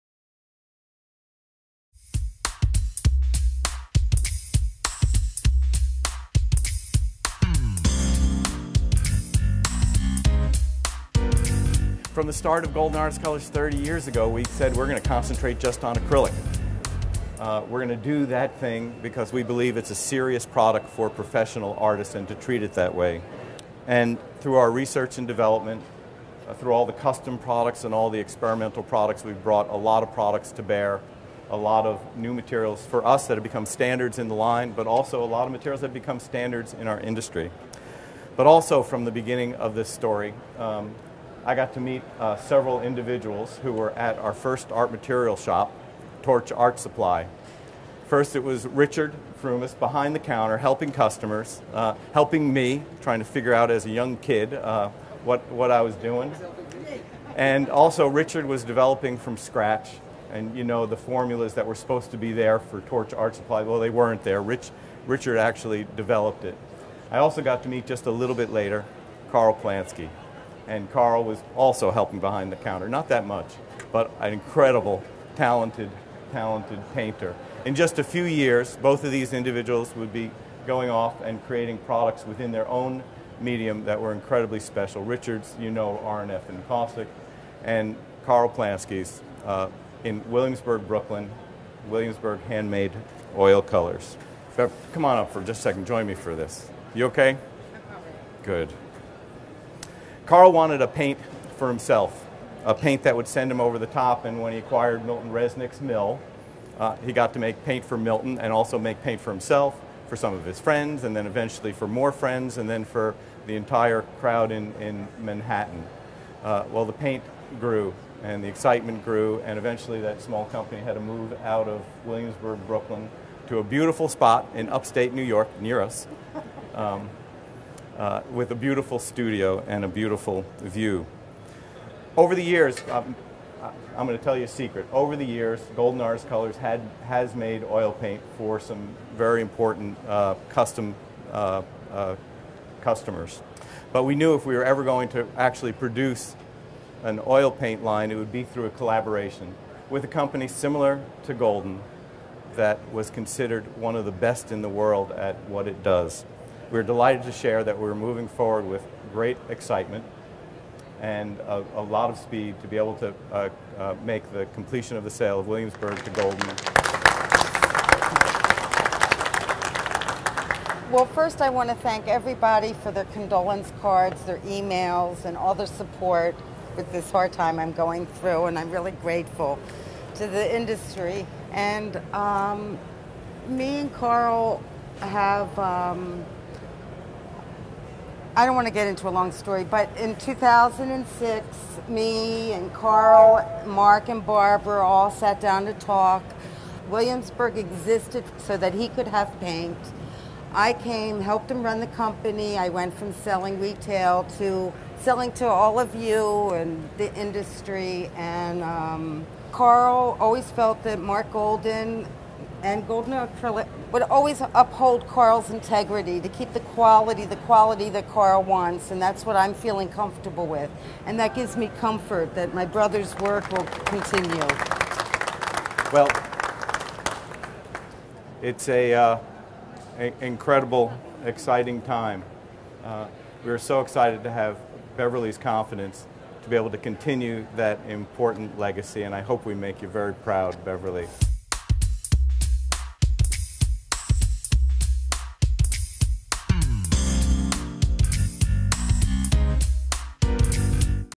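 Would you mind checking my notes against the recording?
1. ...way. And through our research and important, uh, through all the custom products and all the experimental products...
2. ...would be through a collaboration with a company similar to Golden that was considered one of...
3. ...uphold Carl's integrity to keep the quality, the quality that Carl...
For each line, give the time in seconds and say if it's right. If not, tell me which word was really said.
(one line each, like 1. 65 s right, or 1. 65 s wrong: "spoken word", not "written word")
1. 22 s wrong: "development", not "important"
2. 148 s right
3. 214 s right.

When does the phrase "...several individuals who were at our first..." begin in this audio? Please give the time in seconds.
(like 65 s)
42 s.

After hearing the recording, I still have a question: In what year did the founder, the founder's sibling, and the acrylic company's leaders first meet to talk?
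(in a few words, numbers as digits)
2006.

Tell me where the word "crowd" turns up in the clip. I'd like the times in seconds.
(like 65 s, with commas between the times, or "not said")
114 s.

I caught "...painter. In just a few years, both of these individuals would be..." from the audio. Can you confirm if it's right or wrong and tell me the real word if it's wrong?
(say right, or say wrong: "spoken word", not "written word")
right.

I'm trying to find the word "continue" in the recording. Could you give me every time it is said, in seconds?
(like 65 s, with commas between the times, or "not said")
223 s, 236 s.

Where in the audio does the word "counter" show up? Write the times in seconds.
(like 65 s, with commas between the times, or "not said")
50 s, 72 s.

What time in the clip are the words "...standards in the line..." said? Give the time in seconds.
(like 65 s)
33 s.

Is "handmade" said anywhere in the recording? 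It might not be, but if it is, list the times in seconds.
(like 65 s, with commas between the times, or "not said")
92 s.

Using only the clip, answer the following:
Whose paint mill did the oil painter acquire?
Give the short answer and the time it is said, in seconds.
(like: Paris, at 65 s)
Milton Resnick, at 105 s.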